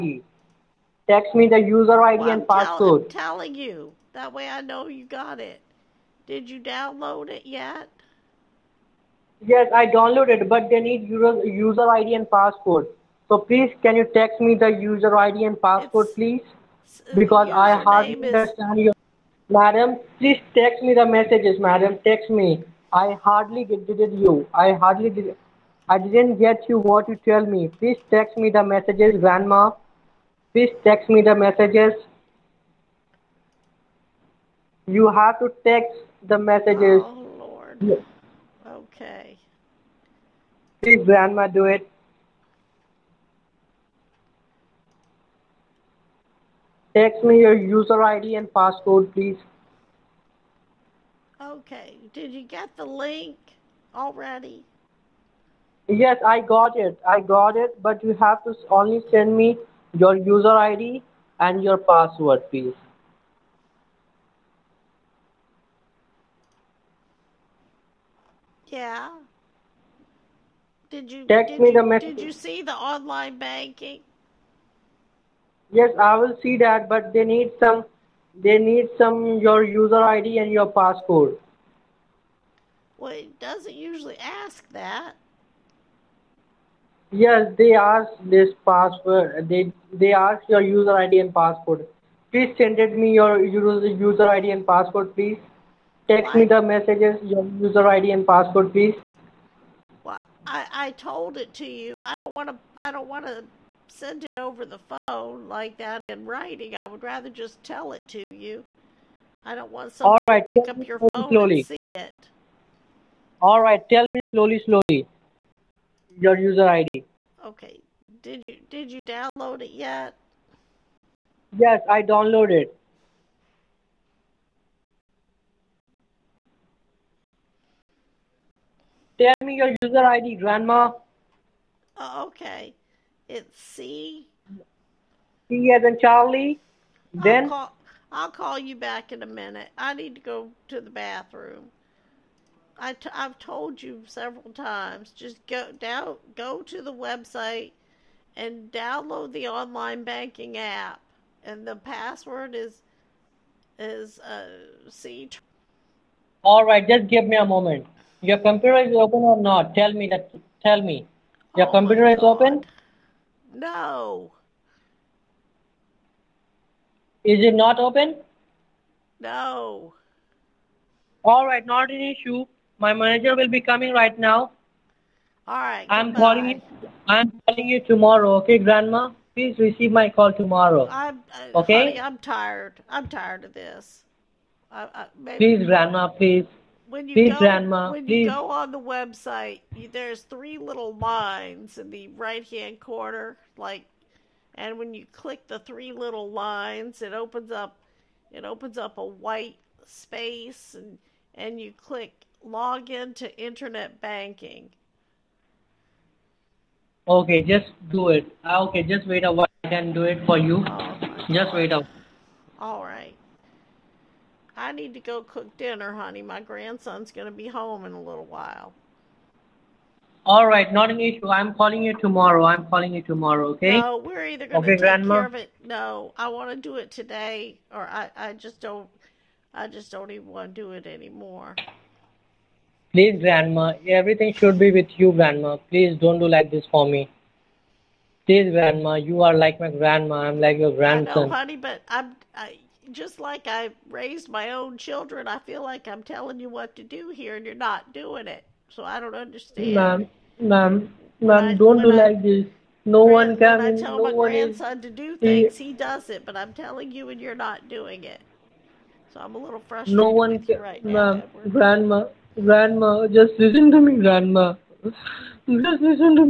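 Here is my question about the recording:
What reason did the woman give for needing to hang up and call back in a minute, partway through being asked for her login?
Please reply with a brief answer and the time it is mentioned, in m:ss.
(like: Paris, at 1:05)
Go to the bathroom, at 2:20.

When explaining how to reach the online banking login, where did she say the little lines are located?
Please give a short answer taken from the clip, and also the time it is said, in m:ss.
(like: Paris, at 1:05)
Right hand corner, at 3:12.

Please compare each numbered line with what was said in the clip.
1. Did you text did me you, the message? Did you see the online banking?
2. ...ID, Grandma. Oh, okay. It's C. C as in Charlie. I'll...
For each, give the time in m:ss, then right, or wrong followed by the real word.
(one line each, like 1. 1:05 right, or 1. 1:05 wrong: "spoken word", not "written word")
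1. 1:10 right
2. 2:10 right.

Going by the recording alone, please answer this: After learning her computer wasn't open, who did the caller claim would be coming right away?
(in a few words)
My manager.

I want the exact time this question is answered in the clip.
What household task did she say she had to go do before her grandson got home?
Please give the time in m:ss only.
3:35.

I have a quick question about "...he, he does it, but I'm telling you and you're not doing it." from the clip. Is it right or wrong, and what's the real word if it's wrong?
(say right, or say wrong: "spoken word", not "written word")
right.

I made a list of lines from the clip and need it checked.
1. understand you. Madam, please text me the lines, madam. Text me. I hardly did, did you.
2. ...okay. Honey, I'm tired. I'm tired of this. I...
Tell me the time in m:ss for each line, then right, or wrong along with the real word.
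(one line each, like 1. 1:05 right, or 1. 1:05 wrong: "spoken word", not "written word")
1. 0:18 wrong: "messages", not "lines"
2. 3:01 right.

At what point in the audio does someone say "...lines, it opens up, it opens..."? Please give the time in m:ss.
3:16.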